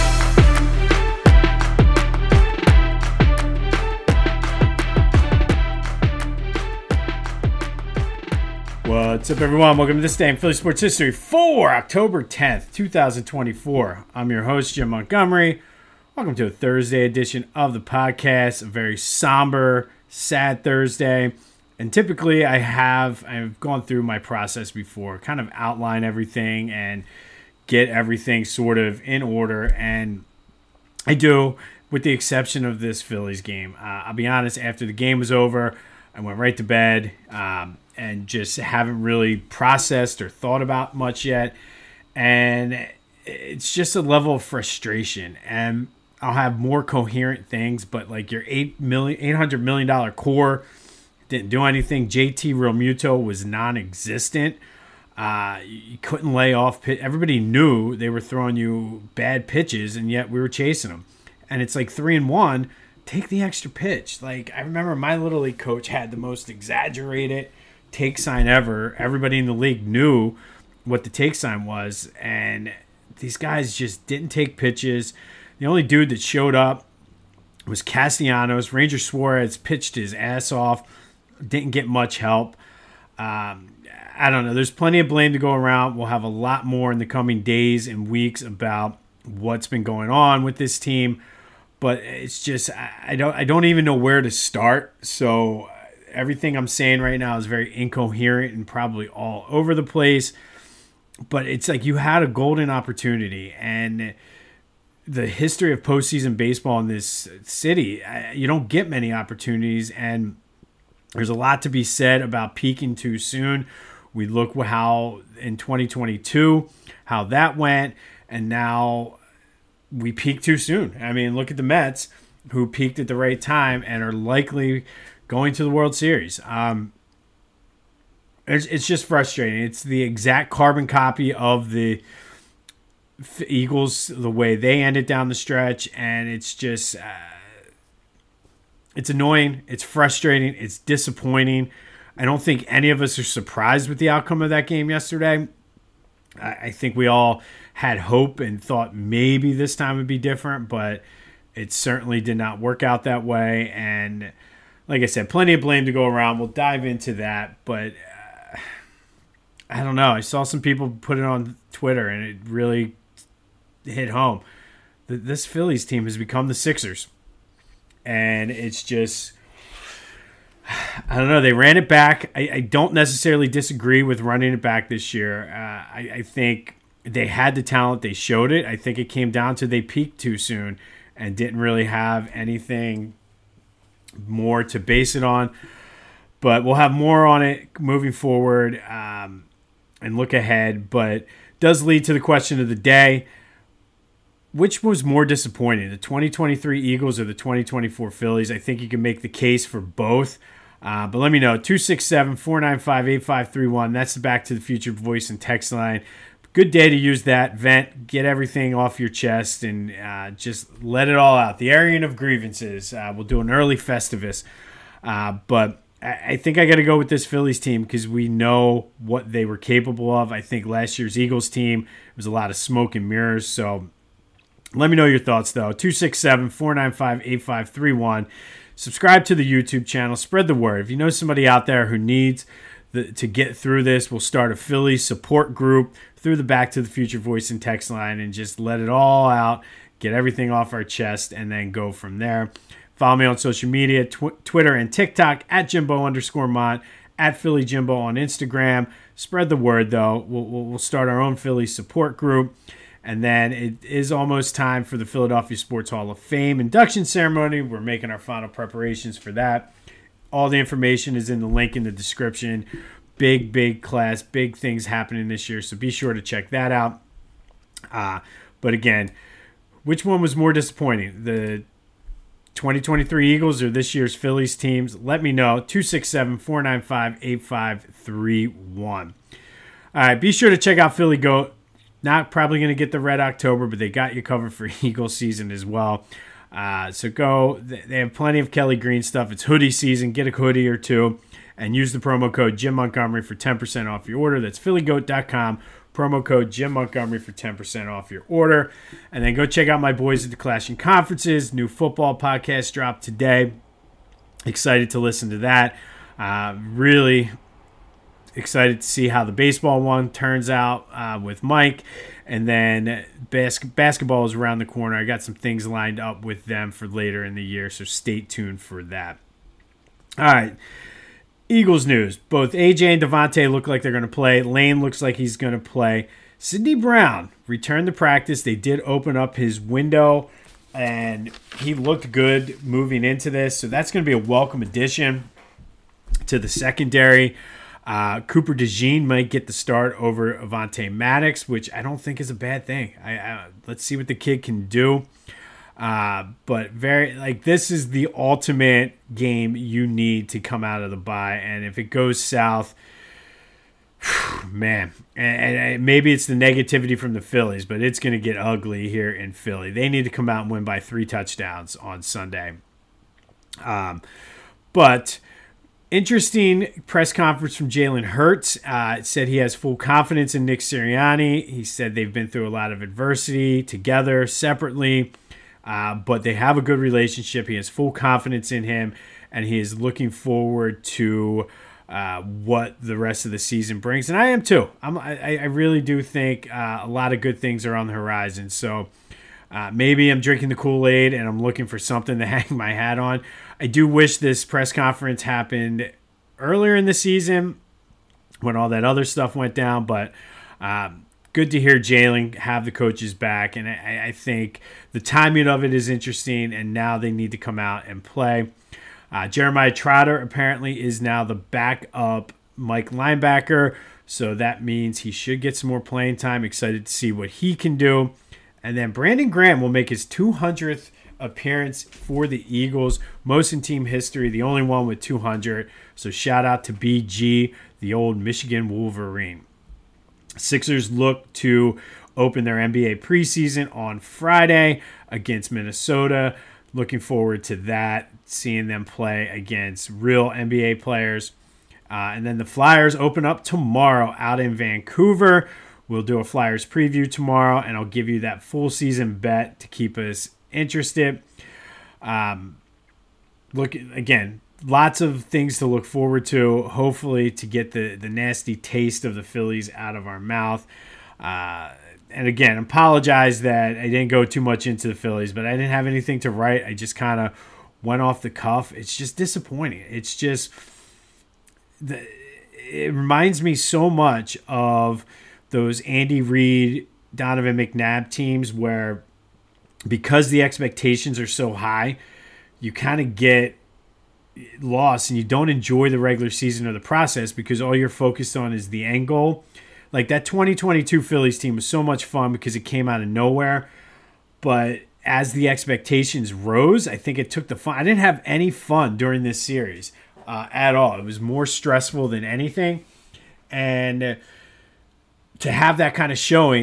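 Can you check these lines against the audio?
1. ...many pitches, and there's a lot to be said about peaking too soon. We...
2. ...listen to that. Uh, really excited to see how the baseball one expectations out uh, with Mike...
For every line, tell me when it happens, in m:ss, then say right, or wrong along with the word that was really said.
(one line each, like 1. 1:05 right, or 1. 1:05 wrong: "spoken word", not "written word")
1. 1:48 wrong: "opportunities", not "pitches"
2. 5:04 wrong: "turns", not "expectations".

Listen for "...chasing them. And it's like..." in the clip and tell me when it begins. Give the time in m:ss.
1:00.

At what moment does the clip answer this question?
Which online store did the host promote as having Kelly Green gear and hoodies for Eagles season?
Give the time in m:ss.
4:40.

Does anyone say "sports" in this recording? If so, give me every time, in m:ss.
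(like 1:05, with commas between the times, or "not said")
0:10, 4:15.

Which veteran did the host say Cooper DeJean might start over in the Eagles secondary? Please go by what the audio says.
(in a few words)
Avonte Maddox.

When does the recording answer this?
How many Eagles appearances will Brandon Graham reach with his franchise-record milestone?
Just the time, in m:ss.
7:00.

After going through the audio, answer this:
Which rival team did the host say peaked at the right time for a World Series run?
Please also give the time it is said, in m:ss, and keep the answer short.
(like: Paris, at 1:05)
Mets, at 2:01.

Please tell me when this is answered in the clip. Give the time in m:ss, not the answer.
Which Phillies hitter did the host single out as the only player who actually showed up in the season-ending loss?
1:17.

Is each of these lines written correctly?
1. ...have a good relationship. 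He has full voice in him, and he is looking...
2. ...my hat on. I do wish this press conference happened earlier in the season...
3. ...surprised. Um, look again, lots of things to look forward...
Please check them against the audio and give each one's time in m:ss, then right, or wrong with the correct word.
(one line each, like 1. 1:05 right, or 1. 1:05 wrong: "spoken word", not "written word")
1. 6:16 wrong: "confidence", not "voice"
2. 6:32 right
3. 7:30 wrong: "interested", not "surprised".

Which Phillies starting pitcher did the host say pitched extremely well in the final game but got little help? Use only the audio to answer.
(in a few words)
Ranger Suarez.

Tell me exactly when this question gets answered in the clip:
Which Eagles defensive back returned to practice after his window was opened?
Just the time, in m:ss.
5:26.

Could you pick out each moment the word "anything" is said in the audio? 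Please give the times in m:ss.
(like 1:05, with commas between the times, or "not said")
0:51, 3:02, 7:45, 8:22.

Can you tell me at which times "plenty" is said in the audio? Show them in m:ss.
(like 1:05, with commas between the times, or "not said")
1:24, 2:35, 4:48.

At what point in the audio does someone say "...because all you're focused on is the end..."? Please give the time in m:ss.
8:07.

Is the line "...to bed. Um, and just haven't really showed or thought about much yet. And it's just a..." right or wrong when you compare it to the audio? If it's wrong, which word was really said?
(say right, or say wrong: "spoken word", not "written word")
wrong: "processed", not "showed".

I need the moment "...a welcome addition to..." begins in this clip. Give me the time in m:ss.
5:34.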